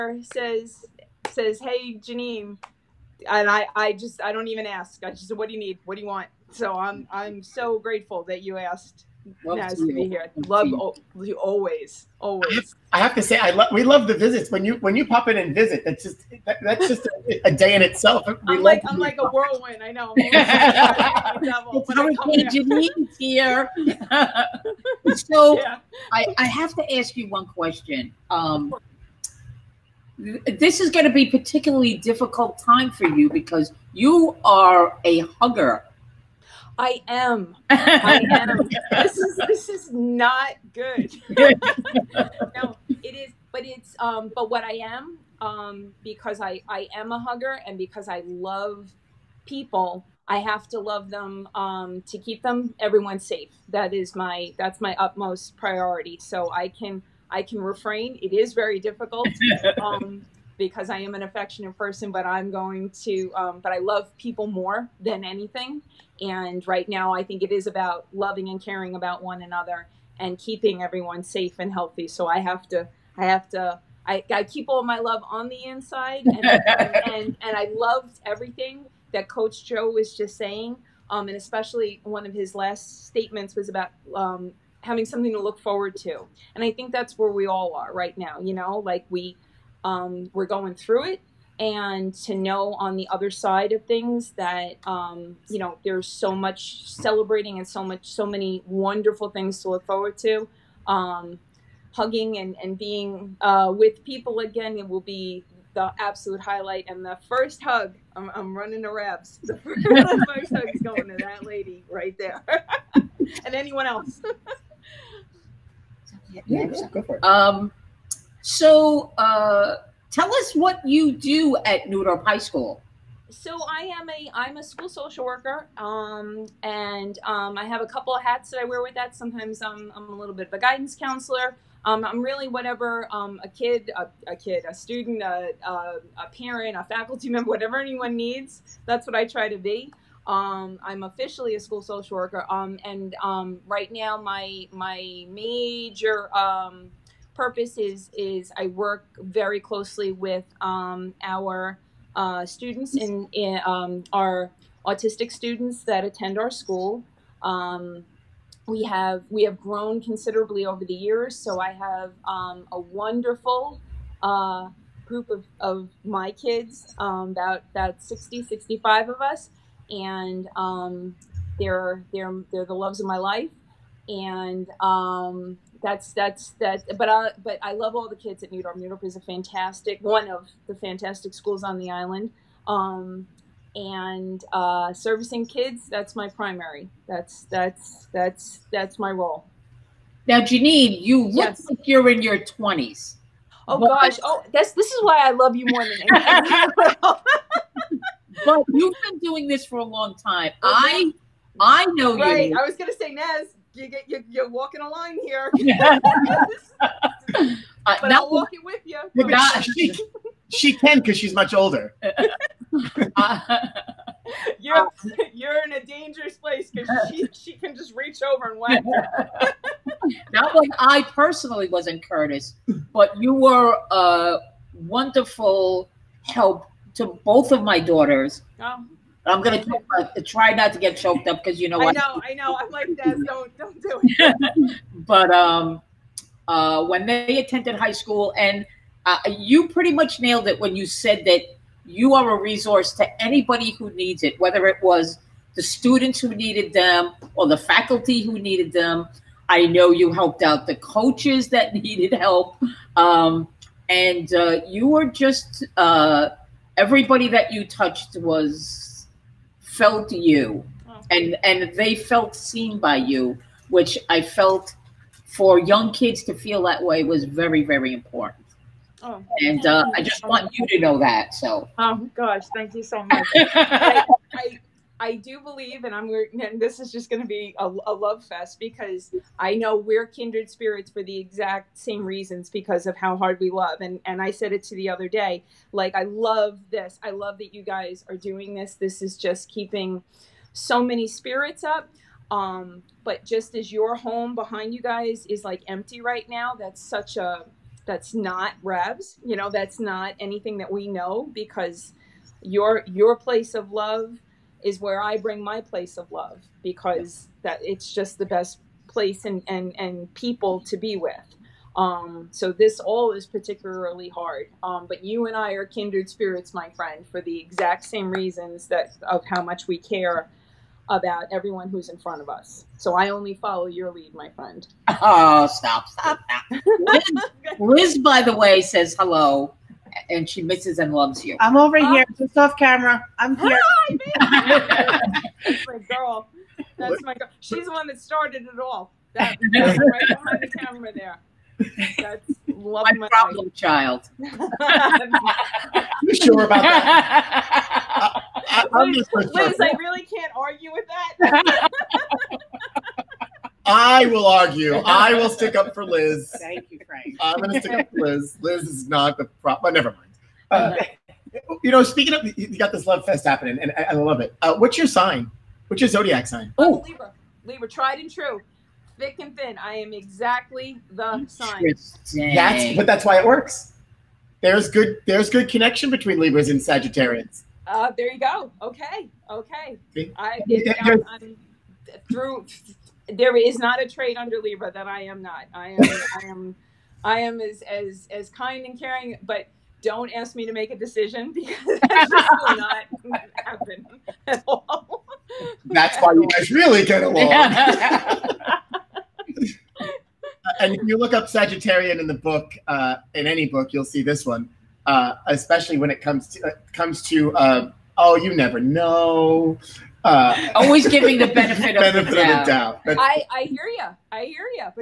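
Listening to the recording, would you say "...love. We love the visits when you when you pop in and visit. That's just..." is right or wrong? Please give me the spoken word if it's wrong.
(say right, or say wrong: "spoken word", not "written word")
right.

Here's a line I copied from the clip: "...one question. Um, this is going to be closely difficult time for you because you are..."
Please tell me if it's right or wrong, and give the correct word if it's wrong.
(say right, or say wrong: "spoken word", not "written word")
wrong: "particularly", not "closely".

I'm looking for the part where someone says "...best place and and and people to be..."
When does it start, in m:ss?
5:08.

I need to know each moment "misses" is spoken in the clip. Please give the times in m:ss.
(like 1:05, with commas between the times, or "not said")
5:30.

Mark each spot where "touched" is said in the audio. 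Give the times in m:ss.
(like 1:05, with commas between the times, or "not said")
4:17.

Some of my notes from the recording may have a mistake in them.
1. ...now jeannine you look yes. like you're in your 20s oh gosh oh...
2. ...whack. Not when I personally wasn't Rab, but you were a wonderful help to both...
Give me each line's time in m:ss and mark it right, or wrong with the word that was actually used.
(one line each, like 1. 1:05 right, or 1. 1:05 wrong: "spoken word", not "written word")
1. 3:10 right
2. 3:38 wrong: "Curtis", not "Rab".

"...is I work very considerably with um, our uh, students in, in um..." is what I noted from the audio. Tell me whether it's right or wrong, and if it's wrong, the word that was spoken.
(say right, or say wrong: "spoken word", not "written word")
wrong: "closely", not "considerably".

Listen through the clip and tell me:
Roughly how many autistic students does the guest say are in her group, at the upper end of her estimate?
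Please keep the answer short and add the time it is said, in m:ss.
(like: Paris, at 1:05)
65, at 2:48.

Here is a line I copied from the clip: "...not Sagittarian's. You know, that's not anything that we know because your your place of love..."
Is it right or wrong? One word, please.
wrong.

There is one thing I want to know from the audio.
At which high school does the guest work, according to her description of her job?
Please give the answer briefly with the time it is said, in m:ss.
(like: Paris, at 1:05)
New Dorp High School, at 2:01.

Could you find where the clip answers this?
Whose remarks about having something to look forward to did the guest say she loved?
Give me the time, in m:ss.
1:19.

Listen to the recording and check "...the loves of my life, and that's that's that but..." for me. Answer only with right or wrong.
right.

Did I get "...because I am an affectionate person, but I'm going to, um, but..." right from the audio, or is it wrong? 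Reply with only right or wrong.
right.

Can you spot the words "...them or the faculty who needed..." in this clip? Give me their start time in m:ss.
4:06.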